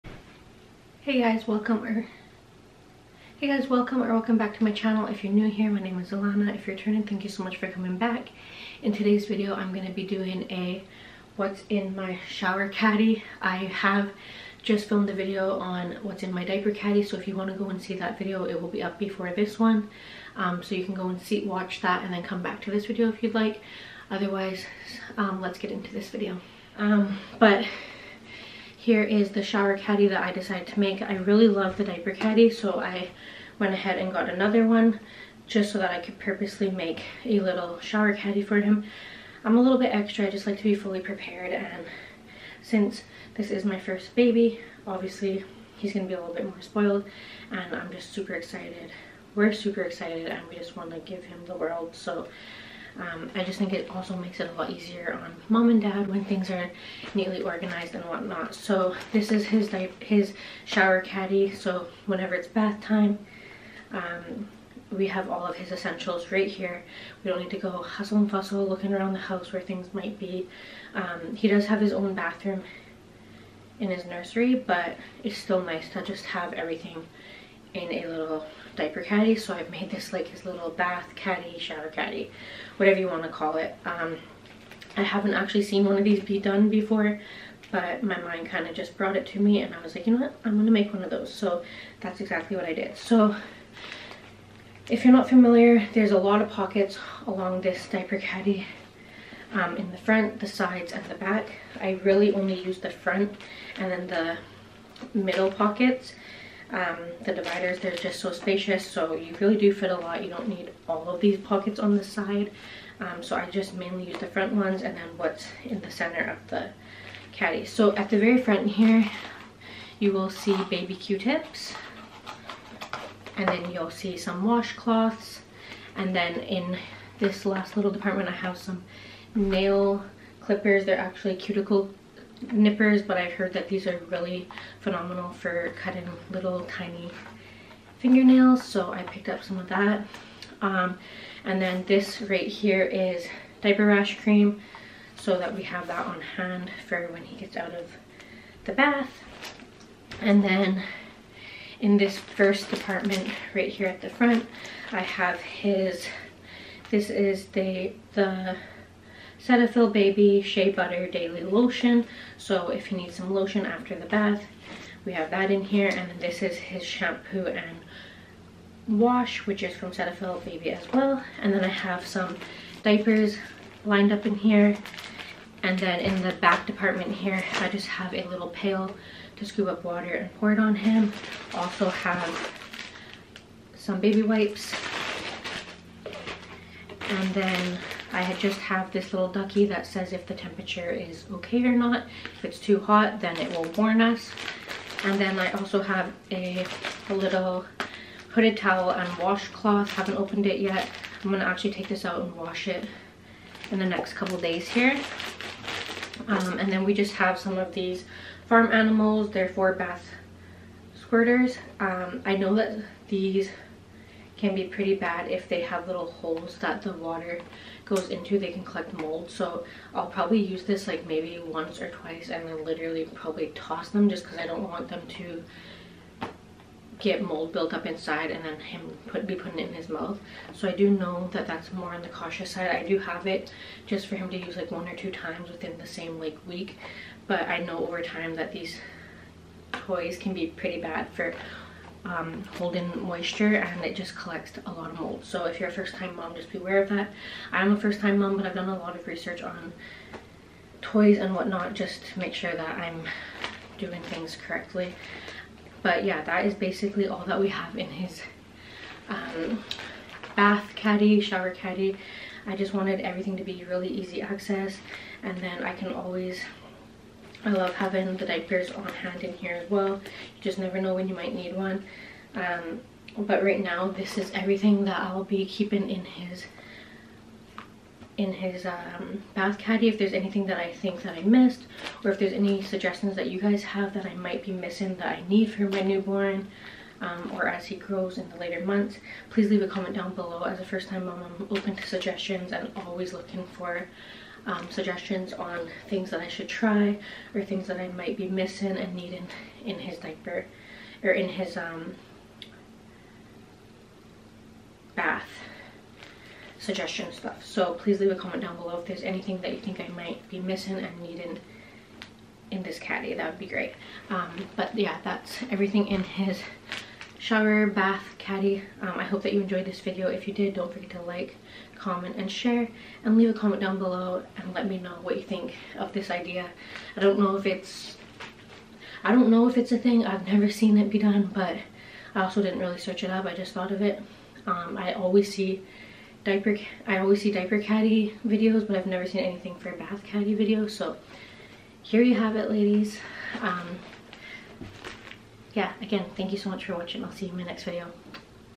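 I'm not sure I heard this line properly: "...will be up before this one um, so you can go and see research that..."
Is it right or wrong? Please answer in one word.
wrong.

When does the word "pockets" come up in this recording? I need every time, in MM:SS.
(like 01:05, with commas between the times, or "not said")
01:36, 01:45, 01:51.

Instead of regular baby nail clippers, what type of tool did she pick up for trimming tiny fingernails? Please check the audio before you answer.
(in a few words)
Cuticle nippers.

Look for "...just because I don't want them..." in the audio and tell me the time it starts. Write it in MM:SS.
03:44.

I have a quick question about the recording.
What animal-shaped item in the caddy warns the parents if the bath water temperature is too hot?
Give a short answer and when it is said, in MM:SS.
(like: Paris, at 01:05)
Ducky, at 03:09.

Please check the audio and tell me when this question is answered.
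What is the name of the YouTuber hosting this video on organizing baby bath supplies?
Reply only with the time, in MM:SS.
00:06.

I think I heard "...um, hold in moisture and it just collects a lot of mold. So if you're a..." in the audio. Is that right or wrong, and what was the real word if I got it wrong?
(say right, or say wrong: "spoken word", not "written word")
right.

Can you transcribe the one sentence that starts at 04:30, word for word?
You just never know when you might need one.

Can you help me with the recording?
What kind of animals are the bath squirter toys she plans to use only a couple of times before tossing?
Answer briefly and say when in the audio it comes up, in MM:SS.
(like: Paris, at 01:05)
Farm animals, at 03:28.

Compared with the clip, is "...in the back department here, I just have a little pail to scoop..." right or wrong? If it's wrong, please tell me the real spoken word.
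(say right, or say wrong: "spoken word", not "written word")
right.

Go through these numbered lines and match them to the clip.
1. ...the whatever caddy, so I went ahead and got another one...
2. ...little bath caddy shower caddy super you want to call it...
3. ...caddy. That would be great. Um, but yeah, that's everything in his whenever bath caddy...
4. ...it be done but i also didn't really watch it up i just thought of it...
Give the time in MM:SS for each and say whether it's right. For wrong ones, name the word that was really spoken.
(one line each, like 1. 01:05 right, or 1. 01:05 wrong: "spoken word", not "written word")
1. 00:31 wrong: "diaper", not "whatever"
2. 01:20 wrong: "whatever", not "super"
3. 05:12 wrong: "shower", not "whenever"
4. 05:30 wrong: "search", not "watch".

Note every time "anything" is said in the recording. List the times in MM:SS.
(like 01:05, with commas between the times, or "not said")
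04:40, 05:09, 05:39.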